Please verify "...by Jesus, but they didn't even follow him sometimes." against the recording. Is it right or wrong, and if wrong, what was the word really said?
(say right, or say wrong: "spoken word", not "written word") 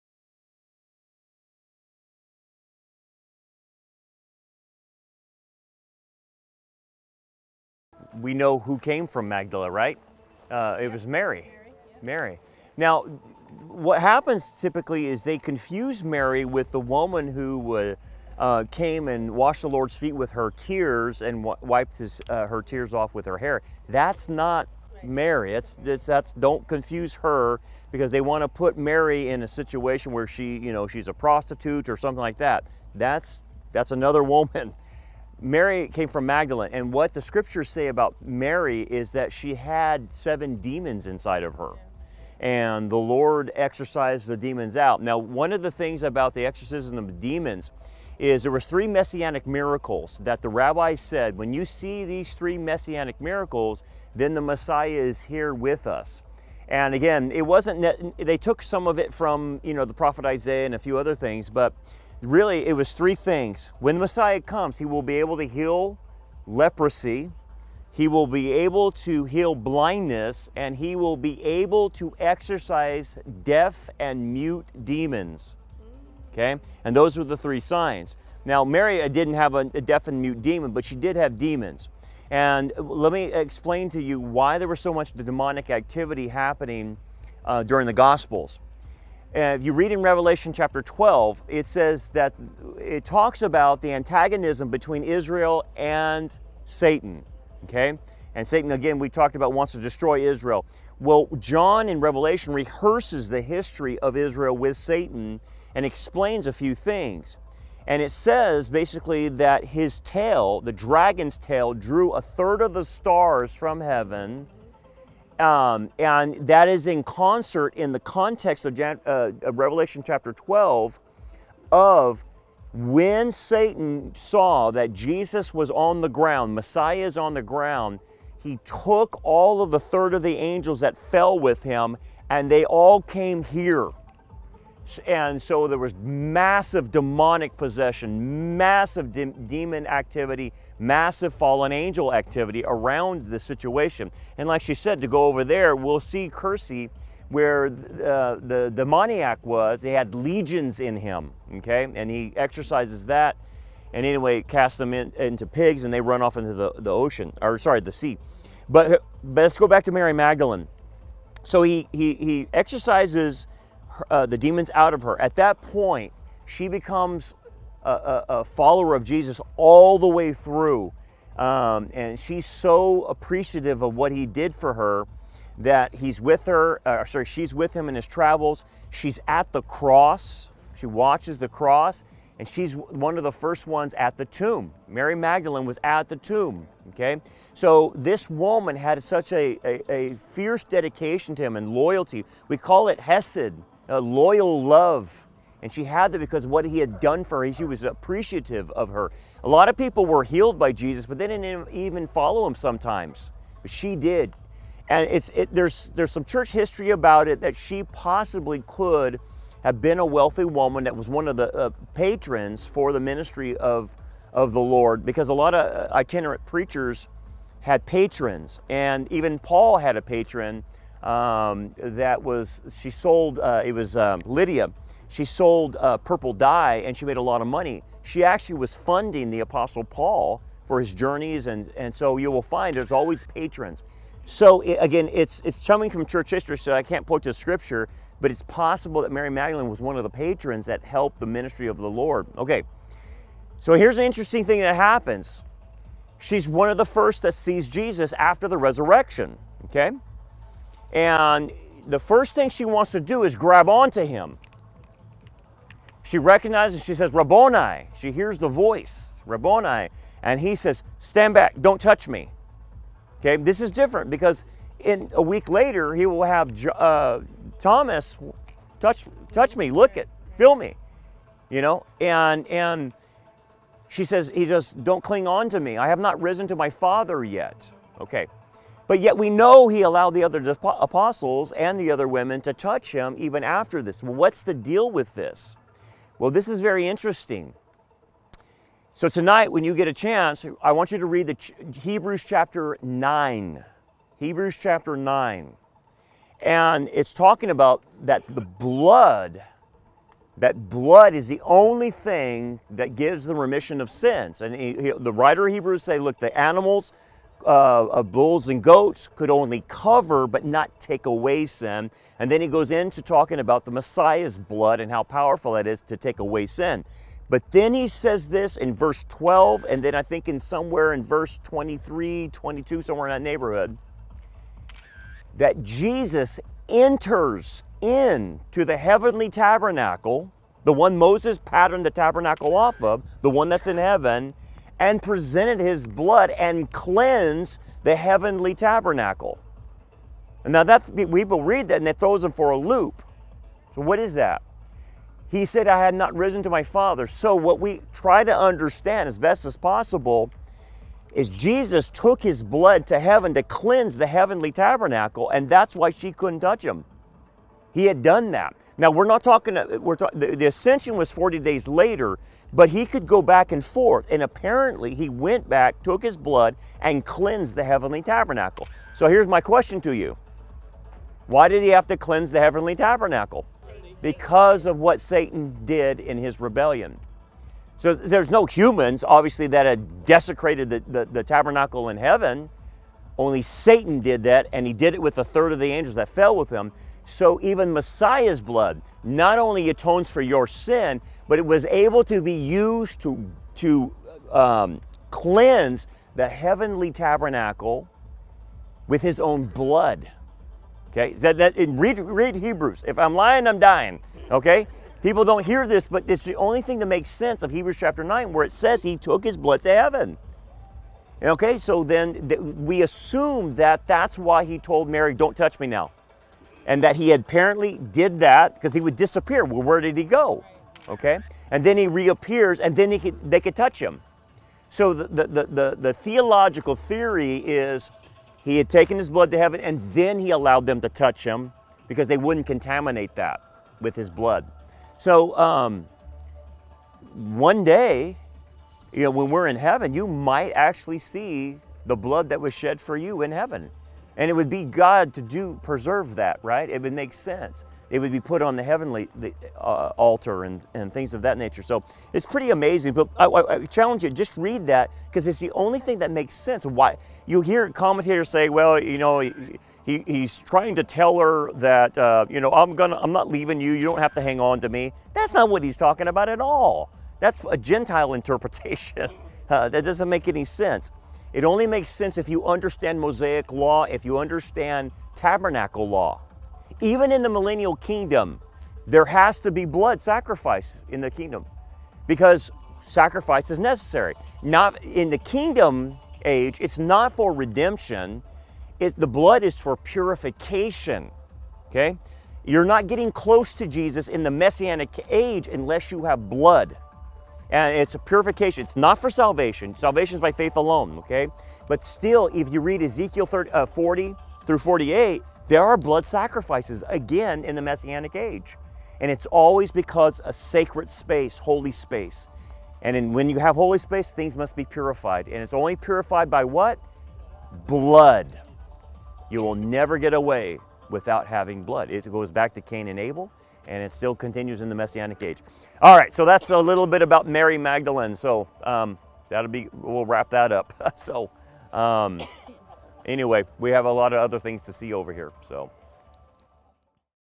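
right.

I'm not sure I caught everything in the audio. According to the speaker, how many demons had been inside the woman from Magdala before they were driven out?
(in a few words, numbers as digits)
7.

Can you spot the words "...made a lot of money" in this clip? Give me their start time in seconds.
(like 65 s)
227 s.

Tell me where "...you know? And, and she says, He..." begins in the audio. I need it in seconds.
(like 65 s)
271 s.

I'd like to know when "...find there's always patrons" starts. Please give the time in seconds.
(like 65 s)
232 s.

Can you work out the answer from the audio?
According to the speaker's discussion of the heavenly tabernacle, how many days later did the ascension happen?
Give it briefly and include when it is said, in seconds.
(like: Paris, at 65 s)
40, at 361 s.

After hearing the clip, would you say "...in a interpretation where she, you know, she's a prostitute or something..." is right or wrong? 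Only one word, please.
wrong.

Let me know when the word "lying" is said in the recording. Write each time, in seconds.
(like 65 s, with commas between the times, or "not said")
403 s.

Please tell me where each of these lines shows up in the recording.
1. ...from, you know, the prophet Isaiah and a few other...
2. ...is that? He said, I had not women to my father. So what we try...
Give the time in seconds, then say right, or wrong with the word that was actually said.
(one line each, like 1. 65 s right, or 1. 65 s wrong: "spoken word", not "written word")
1. 59 s right
2. 343 s wrong: "risen", not "women".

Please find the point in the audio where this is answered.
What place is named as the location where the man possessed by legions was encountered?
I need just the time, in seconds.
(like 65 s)
146 s.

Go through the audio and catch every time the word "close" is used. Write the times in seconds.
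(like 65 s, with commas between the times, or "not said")
493 s.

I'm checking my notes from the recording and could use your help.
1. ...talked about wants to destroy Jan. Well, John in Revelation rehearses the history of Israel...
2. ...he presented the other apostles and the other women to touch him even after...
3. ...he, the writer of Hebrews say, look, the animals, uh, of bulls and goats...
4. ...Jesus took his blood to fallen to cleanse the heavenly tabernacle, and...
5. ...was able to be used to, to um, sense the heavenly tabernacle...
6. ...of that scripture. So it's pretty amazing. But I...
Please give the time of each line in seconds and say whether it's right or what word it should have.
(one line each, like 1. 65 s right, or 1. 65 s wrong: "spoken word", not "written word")
1. 99 s wrong: "Israel", not "Jan"
2. 279 s wrong: "allowed", not "presented"
3. 304 s right
4. 351 s wrong: "heaven", not "fallen"
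5. 391 s wrong: "cleanse", not "sense"
6. 451 s wrong: "nature", not "scripture".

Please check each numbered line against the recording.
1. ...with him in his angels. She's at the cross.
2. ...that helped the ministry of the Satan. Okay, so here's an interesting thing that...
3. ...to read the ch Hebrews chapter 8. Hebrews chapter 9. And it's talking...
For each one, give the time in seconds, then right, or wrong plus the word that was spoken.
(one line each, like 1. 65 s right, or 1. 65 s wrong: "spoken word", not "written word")
1. 177 s wrong: "travels", not "angels"
2. 240 s wrong: "Lord", not "Satan"
3. 290 s wrong: "9", not "8".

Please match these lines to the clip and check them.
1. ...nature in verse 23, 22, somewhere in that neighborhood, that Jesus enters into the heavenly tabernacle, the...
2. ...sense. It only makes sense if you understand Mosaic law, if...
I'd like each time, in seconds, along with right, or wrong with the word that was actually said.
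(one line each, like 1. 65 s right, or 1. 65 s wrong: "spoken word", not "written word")
1. 320 s wrong: "somewhere", not "nature"
2. 470 s right.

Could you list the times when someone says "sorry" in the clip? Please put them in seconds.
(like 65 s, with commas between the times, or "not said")
157 s, 177 s.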